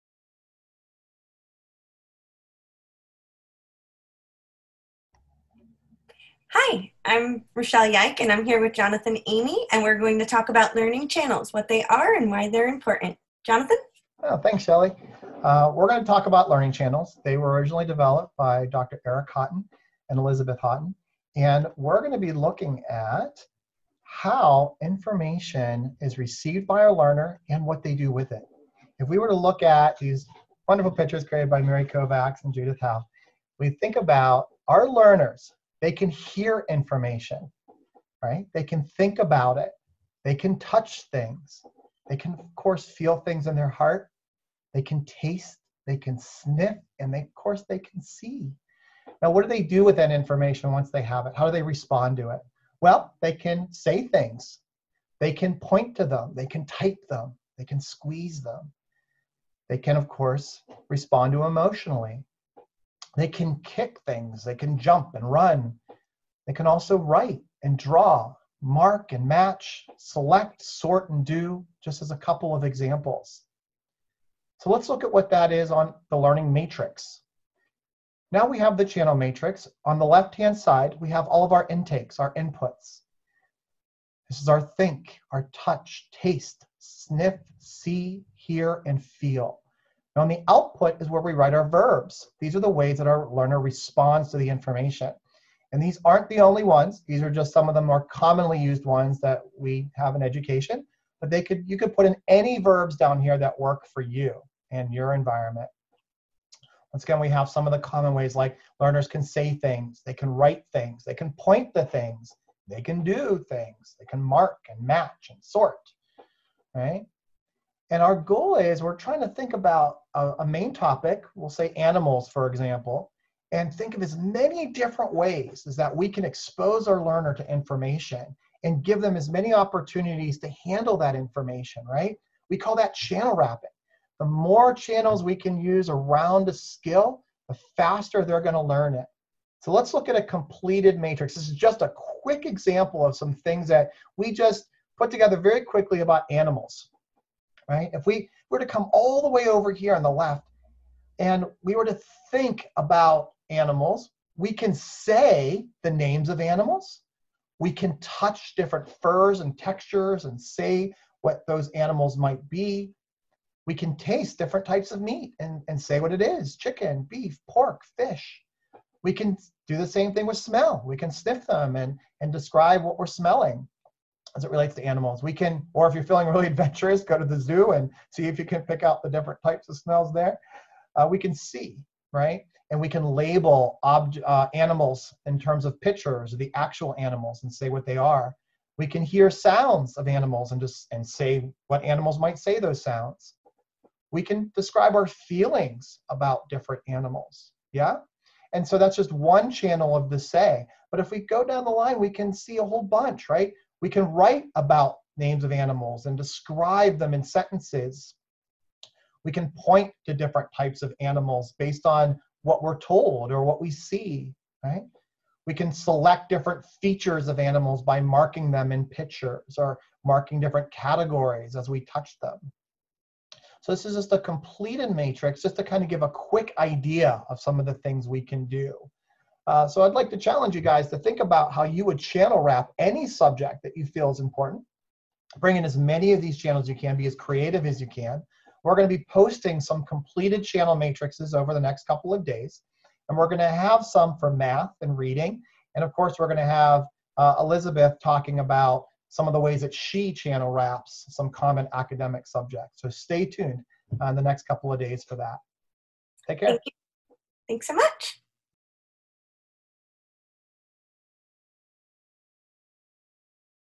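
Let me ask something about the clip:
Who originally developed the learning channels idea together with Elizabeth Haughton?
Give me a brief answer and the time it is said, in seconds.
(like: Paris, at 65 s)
Dr. Eric Haughton, at 18 s.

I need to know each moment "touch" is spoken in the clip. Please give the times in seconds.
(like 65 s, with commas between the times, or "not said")
40 s, 85 s, 157 s, 221 s.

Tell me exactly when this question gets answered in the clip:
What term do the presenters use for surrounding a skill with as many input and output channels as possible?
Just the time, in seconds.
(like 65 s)
132 s.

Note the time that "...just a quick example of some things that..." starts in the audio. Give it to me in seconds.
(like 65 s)
141 s.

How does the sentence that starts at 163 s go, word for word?
We can taste different types of meat and, and say what it is chicken, beef, pork, fish.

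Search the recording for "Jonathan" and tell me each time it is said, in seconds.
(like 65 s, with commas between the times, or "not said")
8 s, 13 s.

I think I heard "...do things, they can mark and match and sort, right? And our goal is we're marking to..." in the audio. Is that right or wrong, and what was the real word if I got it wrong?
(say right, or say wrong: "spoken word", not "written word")
wrong: "trying", not "marking".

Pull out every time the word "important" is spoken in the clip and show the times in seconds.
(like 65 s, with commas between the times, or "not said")
12 s, 234 s.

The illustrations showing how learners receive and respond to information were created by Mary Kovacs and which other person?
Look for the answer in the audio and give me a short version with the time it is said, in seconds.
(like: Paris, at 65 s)
Judith Howe, at 32 s.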